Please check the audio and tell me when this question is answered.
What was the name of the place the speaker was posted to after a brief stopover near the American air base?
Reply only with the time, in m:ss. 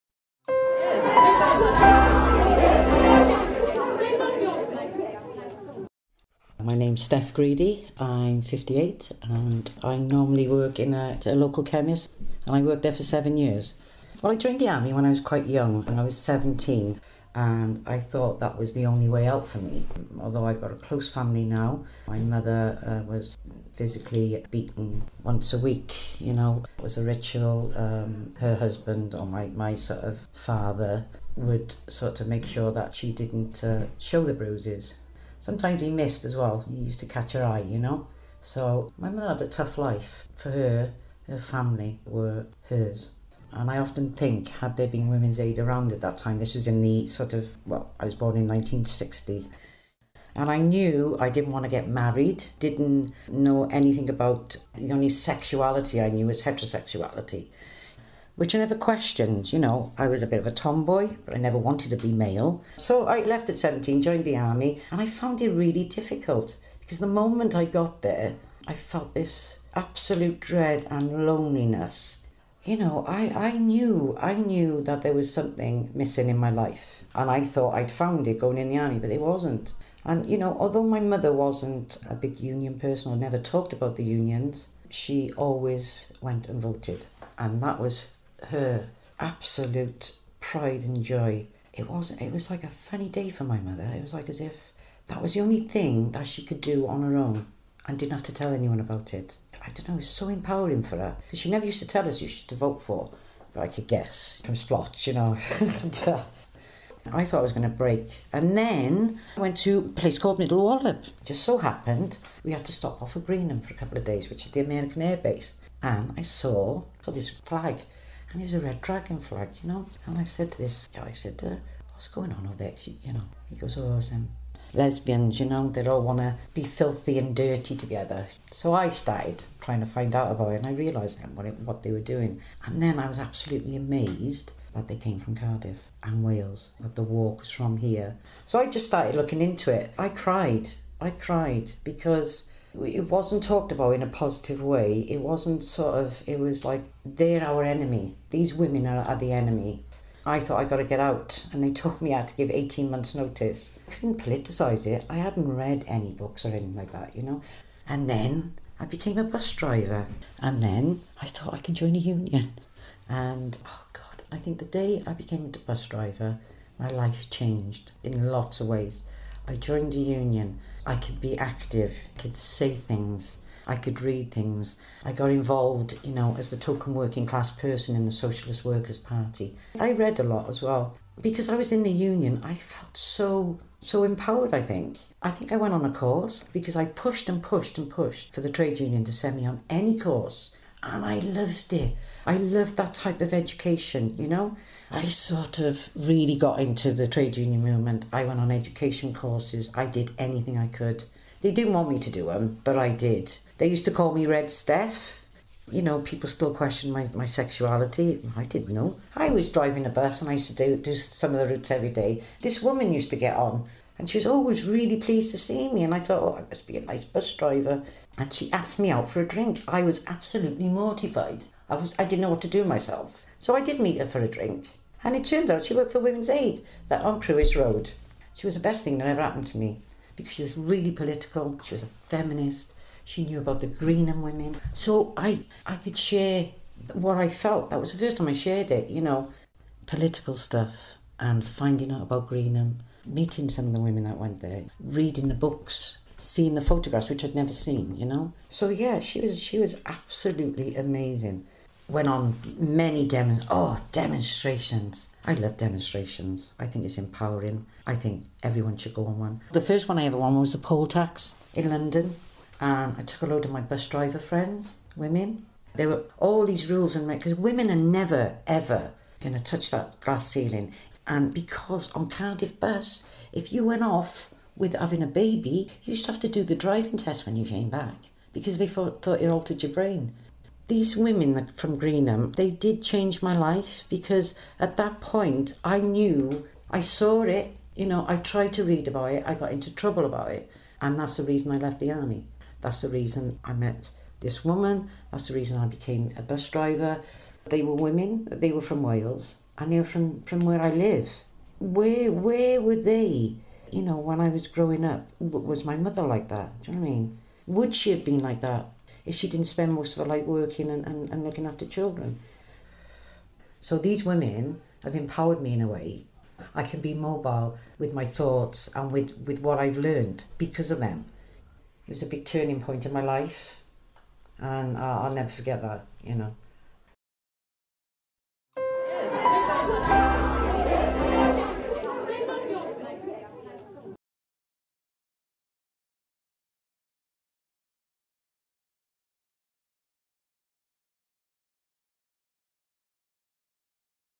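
1:50.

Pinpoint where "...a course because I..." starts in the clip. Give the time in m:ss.
3:05.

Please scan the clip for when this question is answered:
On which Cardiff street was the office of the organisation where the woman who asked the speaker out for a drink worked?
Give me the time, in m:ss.
3:47.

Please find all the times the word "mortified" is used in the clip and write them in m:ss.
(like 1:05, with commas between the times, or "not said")
3:40.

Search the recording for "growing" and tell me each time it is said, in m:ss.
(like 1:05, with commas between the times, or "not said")
5:04.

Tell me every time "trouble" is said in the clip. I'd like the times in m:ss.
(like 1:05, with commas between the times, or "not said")
4:49.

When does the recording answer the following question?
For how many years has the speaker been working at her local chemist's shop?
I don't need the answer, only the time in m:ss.
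0:13.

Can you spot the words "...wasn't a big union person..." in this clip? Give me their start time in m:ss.
1:21.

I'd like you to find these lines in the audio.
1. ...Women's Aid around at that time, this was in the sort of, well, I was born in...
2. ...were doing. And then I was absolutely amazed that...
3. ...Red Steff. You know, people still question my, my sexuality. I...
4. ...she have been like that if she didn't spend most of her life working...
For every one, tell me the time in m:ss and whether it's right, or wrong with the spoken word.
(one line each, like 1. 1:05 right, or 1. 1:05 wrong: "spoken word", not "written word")
1. 0:45 right
2. 2:11 right
3. 3:24 right
4. 5:07 right.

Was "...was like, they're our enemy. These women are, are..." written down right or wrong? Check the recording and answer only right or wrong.
right.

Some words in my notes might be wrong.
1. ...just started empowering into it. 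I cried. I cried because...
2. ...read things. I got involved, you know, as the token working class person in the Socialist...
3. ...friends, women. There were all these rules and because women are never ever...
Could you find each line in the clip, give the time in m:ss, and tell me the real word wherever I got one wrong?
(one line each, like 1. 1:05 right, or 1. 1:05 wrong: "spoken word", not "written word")
1. 2:18 wrong: "looking", not "empowering"
2. 2:54 right
3. 4:24 right.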